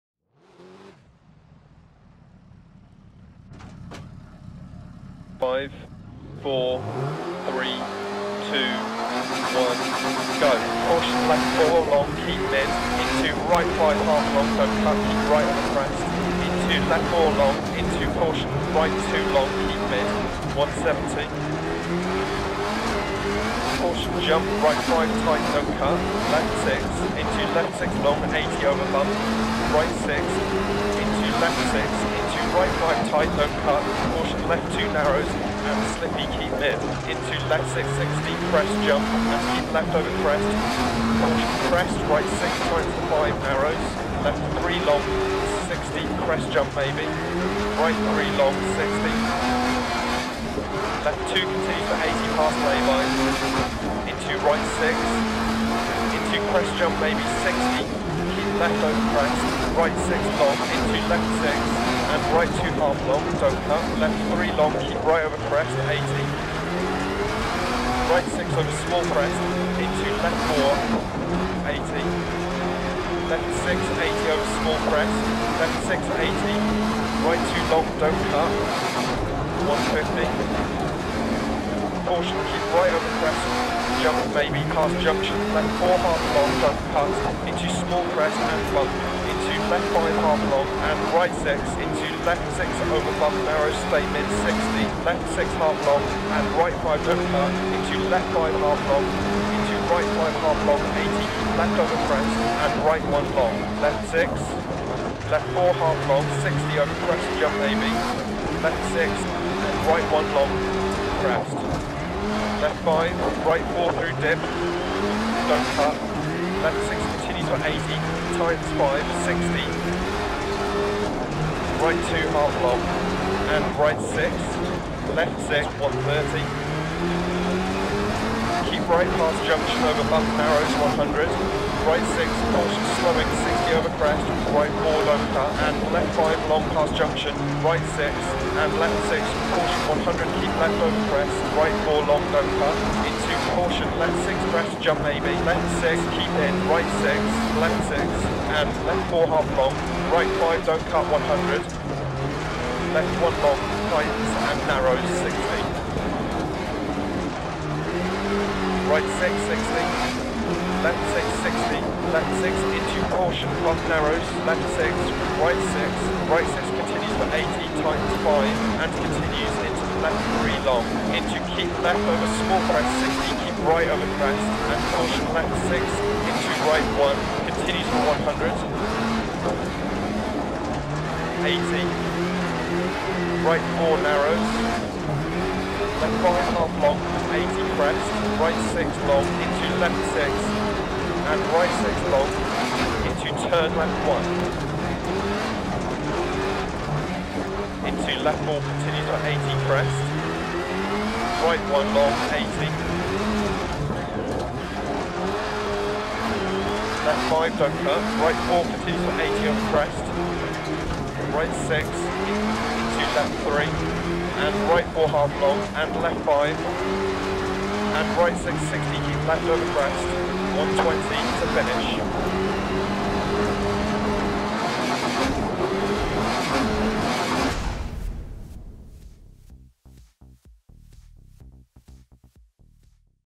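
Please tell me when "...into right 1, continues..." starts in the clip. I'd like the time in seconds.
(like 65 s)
175 s.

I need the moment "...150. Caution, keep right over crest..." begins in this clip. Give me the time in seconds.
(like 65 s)
80 s.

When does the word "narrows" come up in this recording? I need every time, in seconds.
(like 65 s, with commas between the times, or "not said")
34 s, 43 s, 93 s, 130 s, 154 s, 163 s, 184 s.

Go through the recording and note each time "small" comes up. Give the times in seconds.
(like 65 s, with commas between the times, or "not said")
68 s, 74 s, 87 s, 172 s.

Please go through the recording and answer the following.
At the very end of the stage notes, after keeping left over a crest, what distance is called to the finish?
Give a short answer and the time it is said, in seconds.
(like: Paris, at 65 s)
120, at 220 s.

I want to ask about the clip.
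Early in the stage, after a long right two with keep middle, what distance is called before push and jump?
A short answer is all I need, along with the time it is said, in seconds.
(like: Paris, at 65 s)
170, at 20 s.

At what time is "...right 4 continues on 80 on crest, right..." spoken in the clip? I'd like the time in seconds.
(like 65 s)
208 s.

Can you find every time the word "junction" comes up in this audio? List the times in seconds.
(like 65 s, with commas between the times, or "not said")
84 s, 129 s, 136 s.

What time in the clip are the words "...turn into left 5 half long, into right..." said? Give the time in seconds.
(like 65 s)
97 s.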